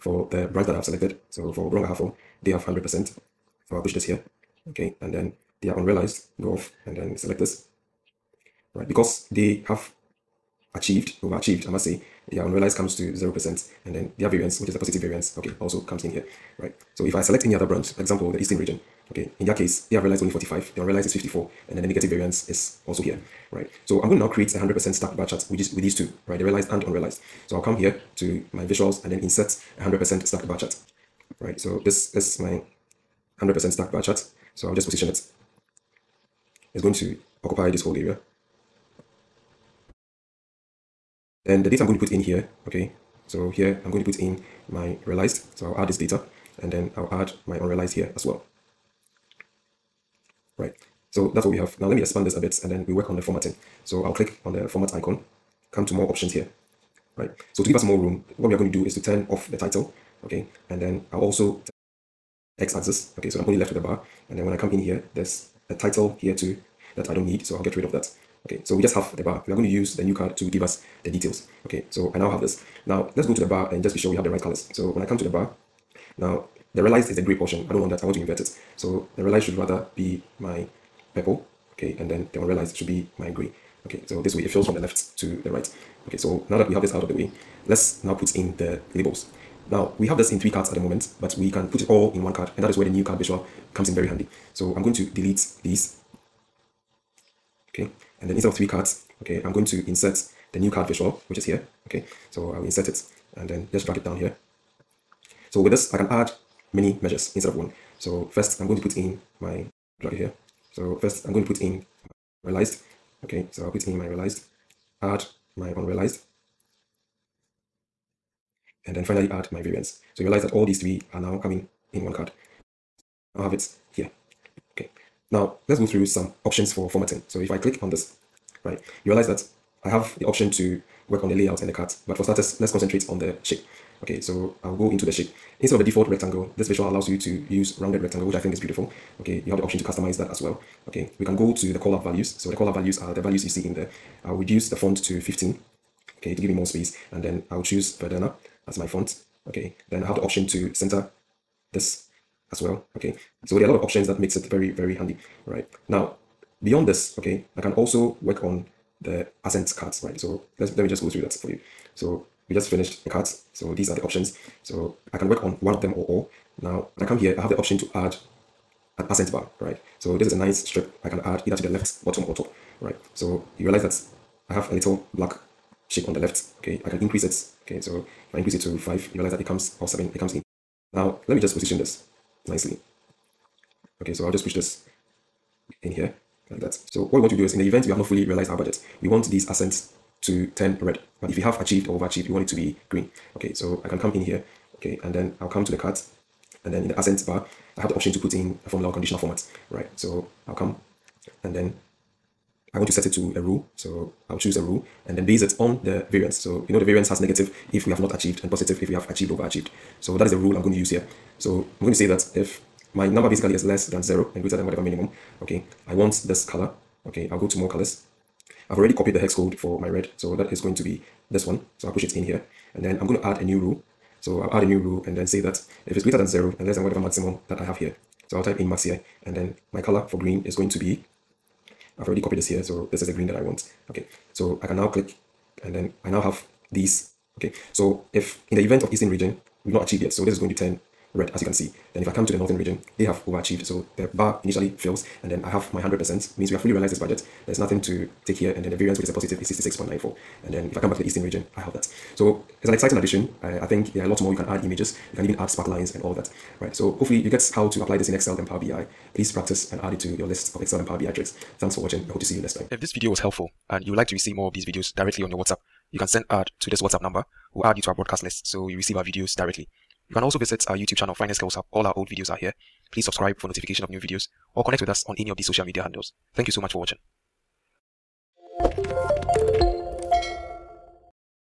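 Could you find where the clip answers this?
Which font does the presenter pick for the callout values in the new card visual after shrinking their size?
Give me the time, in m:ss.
2:27.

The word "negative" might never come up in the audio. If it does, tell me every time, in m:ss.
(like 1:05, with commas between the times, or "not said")
0:21, 3:27.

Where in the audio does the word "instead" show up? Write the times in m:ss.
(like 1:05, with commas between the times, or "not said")
1:38, 1:47, 2:15.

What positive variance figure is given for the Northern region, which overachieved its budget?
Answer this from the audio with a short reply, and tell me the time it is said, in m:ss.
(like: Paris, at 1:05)
66.94, at 4:09.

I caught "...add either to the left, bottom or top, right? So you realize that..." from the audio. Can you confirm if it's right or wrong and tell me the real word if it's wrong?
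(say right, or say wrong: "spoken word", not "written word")
right.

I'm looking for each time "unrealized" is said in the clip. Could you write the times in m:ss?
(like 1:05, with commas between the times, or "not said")
0:05, 0:12, 0:20, 0:26, 0:47, 1:55.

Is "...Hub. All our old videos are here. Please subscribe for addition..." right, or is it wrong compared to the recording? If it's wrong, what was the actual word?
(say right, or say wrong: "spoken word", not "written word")
wrong: "notification", not "addition".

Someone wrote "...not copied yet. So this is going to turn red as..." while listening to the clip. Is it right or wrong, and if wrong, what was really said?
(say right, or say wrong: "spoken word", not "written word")
wrong: "achieved", not "copied".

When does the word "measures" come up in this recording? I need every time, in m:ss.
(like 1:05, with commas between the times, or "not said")
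1:47.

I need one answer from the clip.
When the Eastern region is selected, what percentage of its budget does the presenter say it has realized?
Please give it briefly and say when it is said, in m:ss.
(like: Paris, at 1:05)
45, at 0:20.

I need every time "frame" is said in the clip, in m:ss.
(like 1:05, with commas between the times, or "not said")
not said.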